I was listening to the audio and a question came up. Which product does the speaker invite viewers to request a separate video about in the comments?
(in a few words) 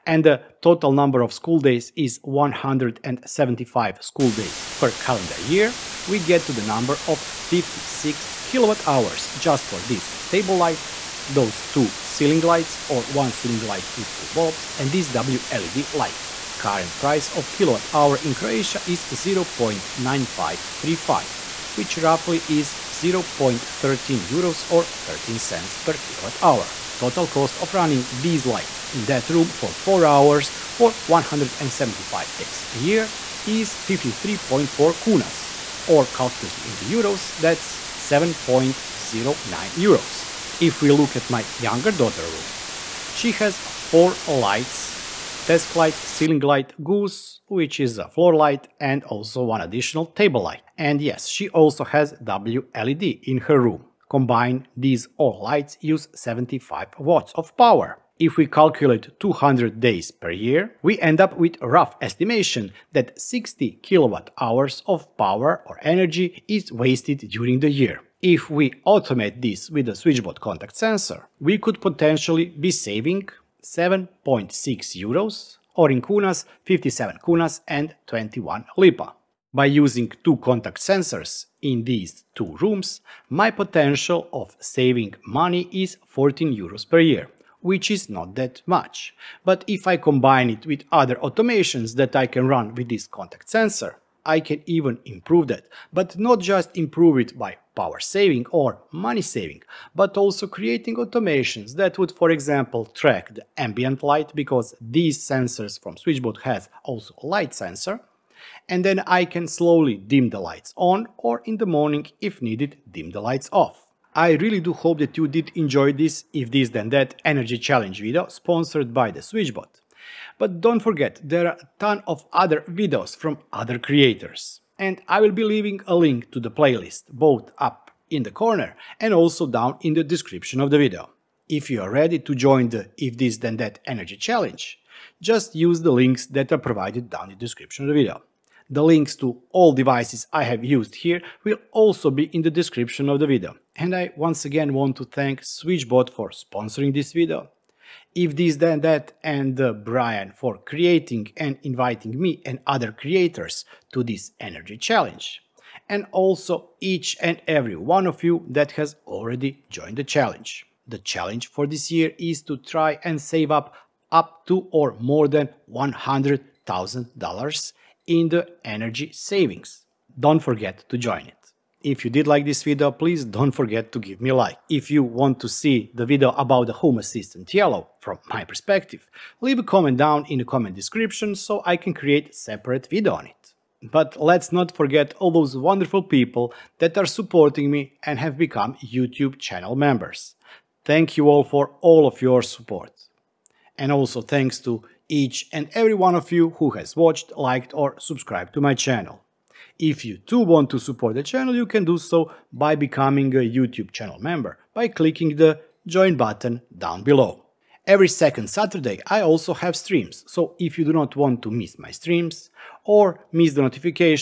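Home Assistant Yellow.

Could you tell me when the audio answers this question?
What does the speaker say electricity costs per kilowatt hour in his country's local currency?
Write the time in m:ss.
0:19.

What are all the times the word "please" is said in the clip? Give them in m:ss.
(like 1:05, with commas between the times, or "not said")
2:52.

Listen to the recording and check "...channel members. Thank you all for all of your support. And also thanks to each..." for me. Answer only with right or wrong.
right.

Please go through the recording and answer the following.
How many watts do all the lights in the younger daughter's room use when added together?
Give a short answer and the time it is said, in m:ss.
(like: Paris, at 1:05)
75 watts, at 0:56.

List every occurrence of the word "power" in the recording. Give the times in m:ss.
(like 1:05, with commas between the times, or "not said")
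0:57, 1:05, 1:37.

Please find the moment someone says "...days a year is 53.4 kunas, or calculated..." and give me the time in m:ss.
0:32.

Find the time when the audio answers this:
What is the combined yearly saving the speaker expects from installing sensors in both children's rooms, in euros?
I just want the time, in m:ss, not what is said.
1:26.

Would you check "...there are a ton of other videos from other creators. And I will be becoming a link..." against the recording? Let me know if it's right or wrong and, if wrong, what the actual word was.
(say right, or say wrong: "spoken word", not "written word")
wrong: "leaving", not "becoming".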